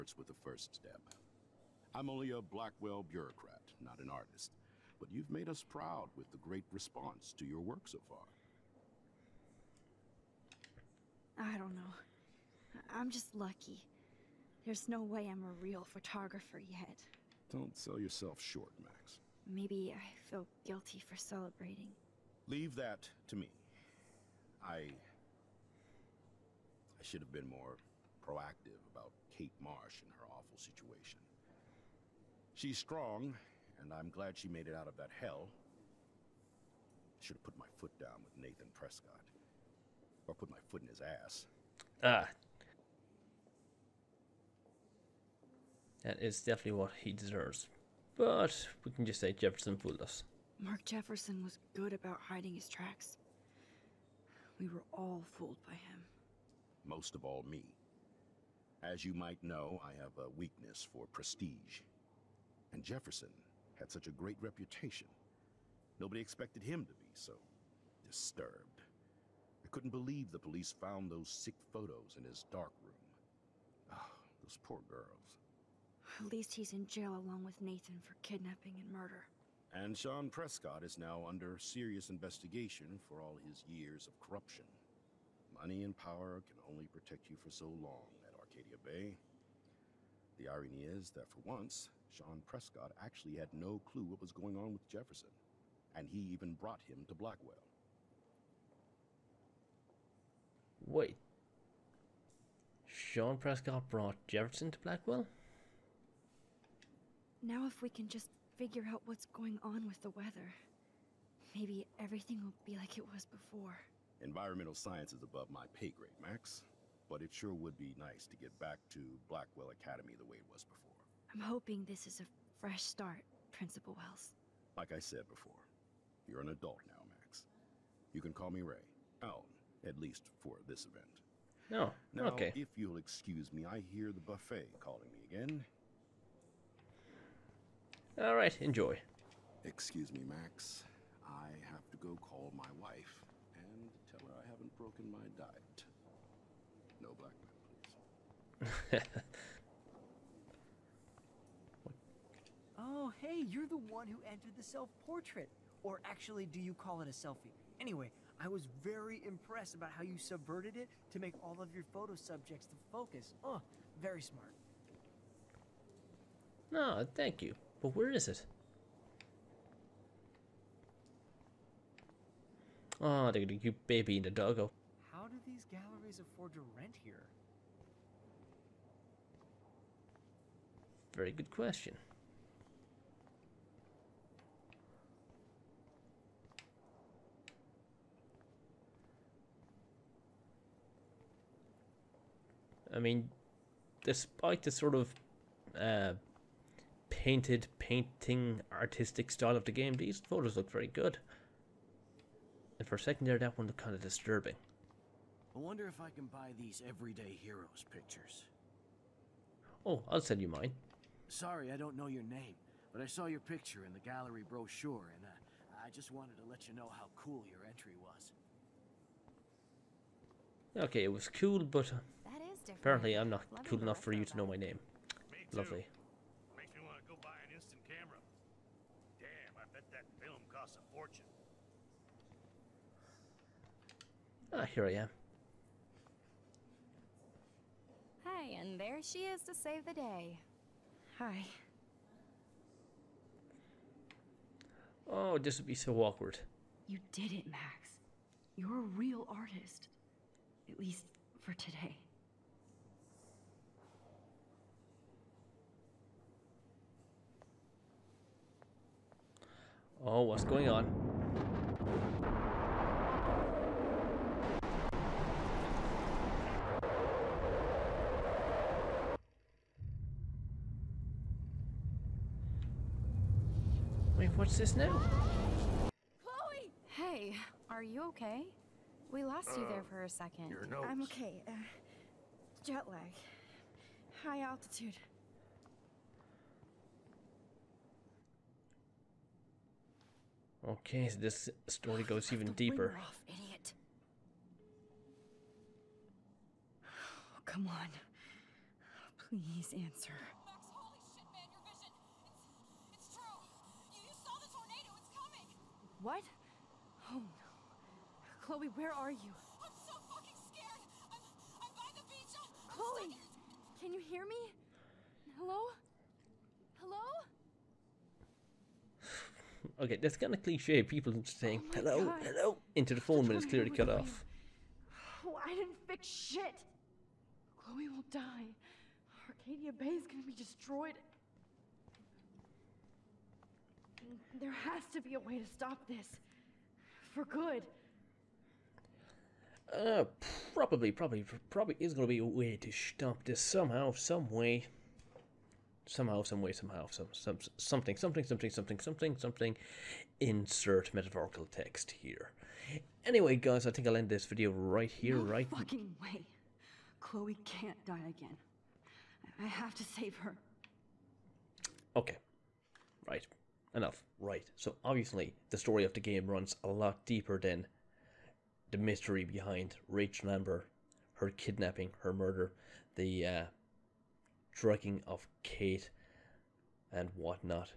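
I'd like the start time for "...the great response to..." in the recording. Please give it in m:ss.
0:06.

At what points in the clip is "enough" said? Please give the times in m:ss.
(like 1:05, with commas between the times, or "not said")
3:43, 6:03.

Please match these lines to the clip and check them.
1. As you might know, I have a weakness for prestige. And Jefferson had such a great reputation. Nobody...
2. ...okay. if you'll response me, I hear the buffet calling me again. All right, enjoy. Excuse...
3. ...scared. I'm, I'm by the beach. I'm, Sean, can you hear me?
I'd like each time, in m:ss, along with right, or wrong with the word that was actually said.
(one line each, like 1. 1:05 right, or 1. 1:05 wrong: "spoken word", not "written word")
1. 0:58 right
2. 2:12 wrong: "excuse", not "response"
3. 5:10 wrong: "Chloe", not "Sean".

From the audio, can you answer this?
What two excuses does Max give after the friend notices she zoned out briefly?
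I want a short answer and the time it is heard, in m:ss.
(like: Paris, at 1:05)
Jet lag, high altitude, at 4:42.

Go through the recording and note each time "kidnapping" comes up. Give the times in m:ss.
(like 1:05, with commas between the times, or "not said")
1:18, 6:11.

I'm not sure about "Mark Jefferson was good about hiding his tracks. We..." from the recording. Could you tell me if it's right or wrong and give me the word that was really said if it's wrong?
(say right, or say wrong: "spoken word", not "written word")
right.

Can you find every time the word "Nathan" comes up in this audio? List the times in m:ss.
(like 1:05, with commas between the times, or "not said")
0:38, 1:17.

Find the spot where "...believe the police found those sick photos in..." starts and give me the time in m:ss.
1:09.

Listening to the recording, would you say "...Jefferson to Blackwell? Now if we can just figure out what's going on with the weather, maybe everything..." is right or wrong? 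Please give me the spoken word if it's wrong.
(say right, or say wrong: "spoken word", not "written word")
right.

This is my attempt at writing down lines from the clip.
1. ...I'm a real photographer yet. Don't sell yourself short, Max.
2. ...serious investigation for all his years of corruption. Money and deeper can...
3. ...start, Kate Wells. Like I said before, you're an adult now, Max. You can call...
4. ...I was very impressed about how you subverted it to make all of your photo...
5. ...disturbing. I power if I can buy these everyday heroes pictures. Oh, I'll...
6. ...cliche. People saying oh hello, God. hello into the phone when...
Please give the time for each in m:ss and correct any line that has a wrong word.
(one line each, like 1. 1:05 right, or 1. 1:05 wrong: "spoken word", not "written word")
1. 0:15 right
2. 1:21 wrong: "power", not "deeper"
3. 2:02 wrong: "Principal", not "Kate"
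4. 2:38 right
5. 3:24 wrong: "wonder", not "power"
6. 5:20 right.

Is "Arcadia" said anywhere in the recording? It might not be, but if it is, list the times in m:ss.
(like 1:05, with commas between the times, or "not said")
1:28, 5:29.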